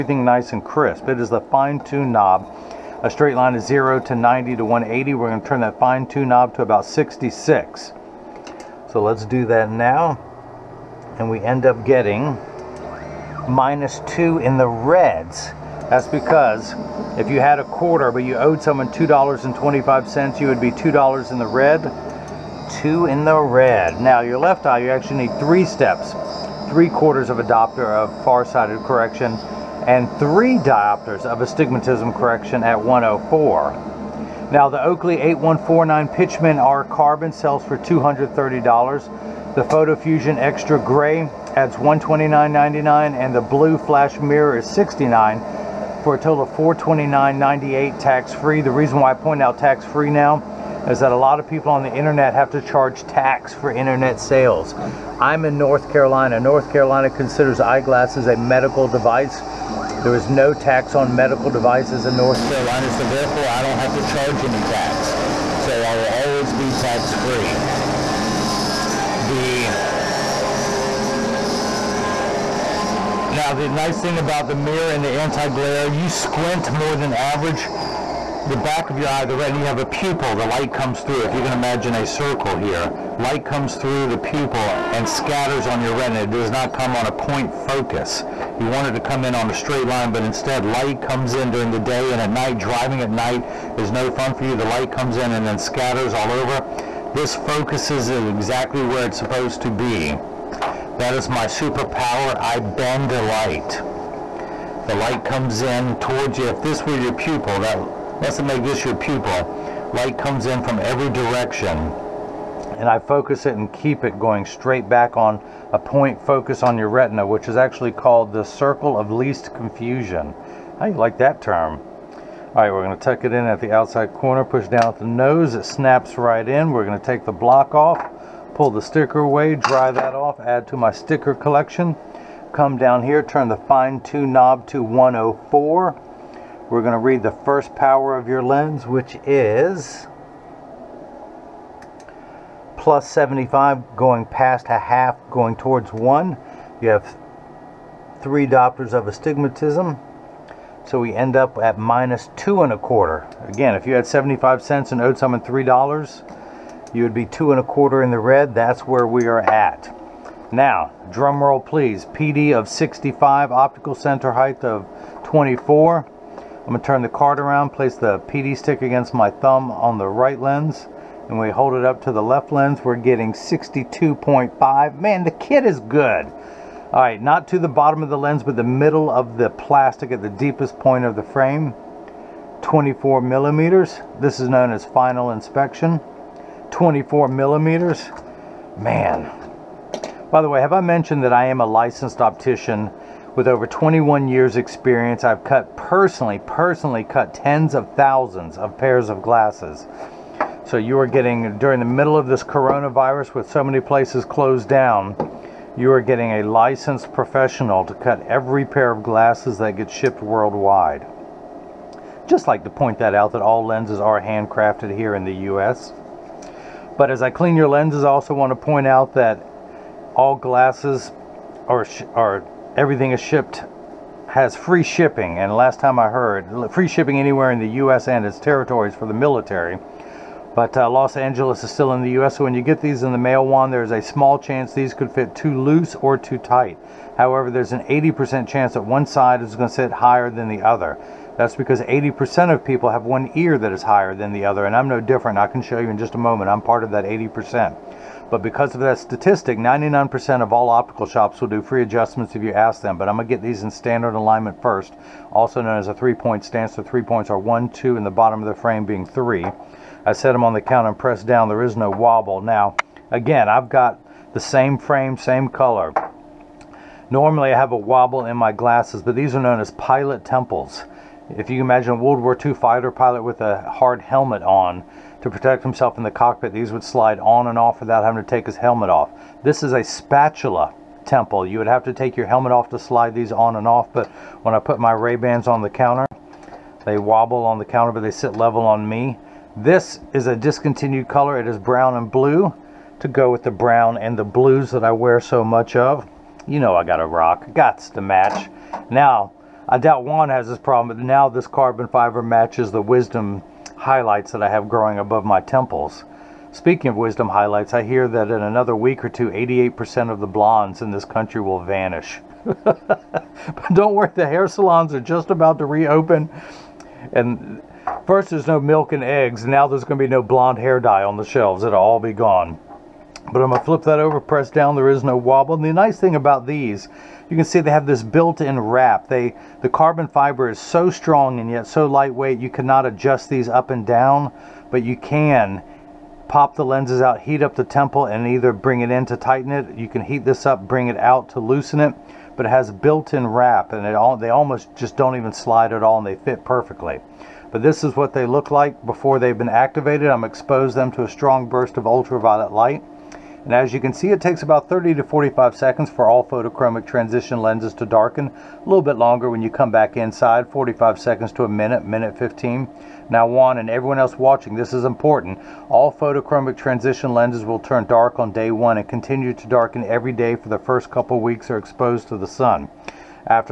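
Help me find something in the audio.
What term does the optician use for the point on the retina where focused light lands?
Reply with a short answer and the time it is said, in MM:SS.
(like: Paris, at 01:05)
circle of least confusion, at 01:58.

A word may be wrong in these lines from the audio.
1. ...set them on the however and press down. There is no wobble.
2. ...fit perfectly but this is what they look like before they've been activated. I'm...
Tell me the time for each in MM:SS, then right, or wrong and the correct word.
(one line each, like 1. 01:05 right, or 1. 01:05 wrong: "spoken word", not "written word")
1. 04:20 wrong: "counter", not "however"
2. 05:46 right.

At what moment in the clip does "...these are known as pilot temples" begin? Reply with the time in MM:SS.
04:29.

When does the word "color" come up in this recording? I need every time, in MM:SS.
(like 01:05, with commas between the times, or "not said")
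04:25, 04:51.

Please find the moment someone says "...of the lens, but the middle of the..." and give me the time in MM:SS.
02:58.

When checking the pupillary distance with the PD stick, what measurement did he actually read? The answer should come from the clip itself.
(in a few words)
62.5.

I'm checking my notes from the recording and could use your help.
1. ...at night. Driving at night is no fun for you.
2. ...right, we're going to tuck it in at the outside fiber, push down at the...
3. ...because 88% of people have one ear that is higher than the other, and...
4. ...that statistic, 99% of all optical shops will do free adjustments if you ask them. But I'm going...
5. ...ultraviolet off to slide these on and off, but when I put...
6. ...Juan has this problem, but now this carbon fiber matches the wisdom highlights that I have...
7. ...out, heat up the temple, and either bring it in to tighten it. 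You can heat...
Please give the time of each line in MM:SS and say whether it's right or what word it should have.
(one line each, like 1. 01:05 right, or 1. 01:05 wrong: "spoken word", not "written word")
1. 01:32 right
2. 02:02 wrong: "corner", not "fiber"
3. 04:01 wrong: "80", not "88"
4. 04:08 right
5. 04:42 wrong: "helmet", not "ultraviolet"
6. 05:00 right
7. 05:37 right.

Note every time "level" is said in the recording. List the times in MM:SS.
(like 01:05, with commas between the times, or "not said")
04:48.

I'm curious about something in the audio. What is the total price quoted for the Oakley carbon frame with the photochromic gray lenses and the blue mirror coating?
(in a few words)
$429.98.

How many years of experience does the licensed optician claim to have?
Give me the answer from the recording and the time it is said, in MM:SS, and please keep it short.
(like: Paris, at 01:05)
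over 21 years, at 03:13.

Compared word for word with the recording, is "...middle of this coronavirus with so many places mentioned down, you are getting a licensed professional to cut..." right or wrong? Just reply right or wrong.
wrong.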